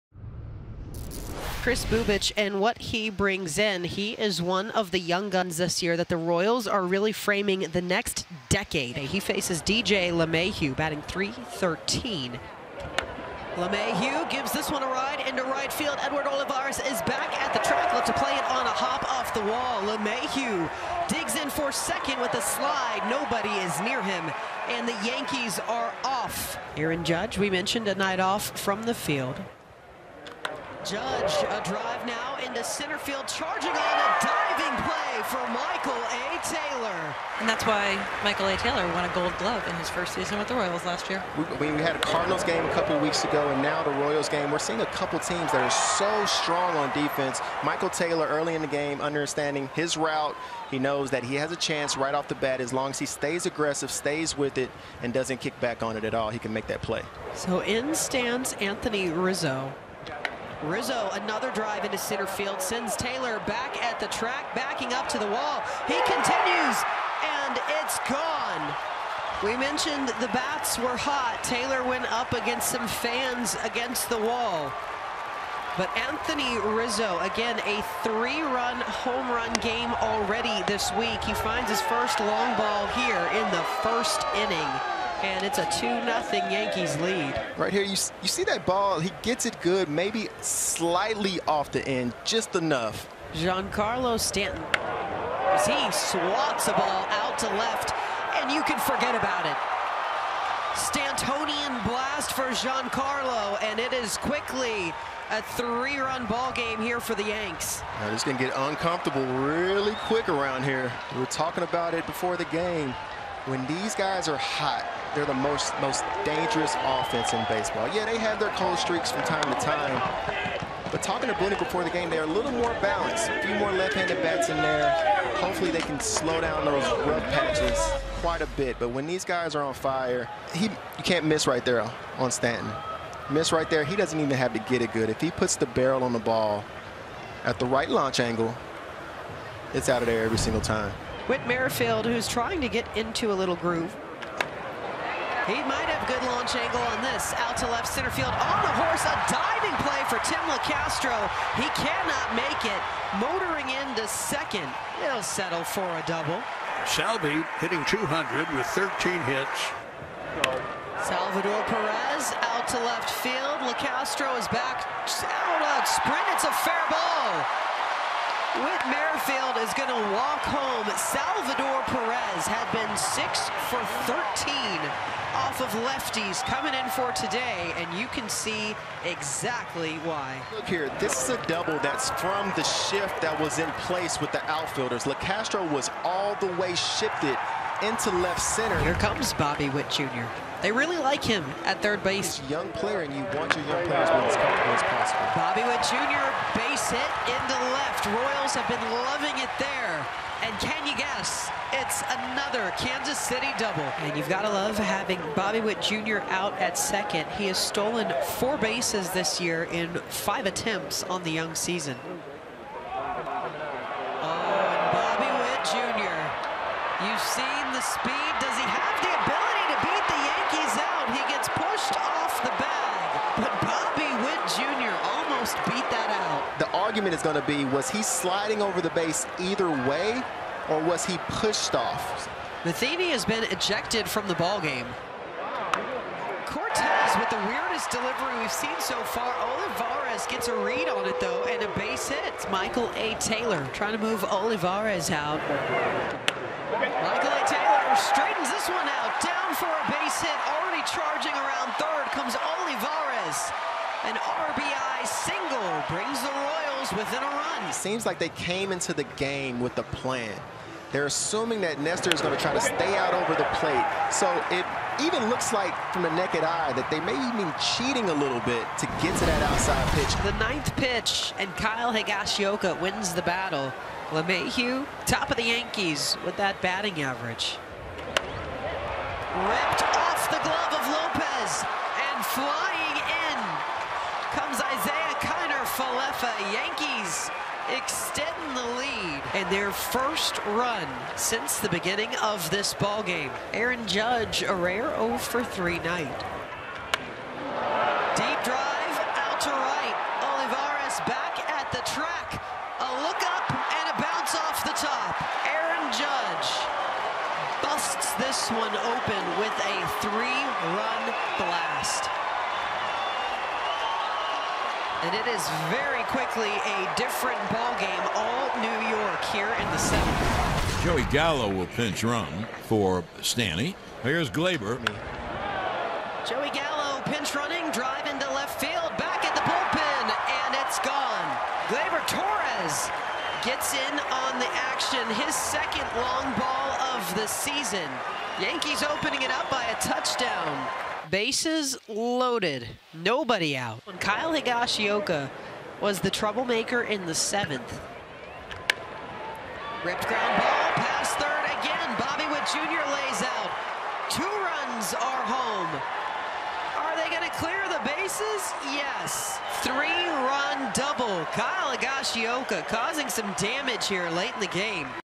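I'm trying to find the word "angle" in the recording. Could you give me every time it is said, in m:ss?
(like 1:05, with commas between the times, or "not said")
2:18, 2:26.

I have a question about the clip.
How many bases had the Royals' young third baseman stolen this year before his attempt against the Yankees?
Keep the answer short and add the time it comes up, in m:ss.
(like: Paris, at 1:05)
4, at 3:28.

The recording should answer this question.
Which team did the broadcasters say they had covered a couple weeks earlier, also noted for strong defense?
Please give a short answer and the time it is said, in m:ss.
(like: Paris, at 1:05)
Cardinals, at 0:41.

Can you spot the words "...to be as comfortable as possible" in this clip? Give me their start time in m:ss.
3:14.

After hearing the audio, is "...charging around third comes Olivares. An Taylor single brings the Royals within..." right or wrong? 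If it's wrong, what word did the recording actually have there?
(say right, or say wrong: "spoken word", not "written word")
wrong: "RBI", not "Taylor".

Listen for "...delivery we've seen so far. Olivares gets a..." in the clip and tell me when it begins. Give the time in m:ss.
3:57.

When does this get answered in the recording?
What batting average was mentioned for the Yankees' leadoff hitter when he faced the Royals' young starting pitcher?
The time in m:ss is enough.
0:10.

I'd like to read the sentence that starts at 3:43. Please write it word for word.
But Bobby Witt Jr almost beat that out.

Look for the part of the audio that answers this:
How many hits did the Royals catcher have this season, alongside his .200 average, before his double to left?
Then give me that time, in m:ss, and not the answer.
2:38.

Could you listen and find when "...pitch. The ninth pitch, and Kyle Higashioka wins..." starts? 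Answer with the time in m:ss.
4:29.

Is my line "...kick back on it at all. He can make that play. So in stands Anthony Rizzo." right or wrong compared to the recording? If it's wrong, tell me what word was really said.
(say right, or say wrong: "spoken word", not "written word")
right.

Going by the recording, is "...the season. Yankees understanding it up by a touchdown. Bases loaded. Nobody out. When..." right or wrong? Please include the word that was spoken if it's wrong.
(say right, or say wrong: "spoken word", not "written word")
wrong: "opening", not "understanding".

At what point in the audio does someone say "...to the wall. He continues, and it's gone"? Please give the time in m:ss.
1:05.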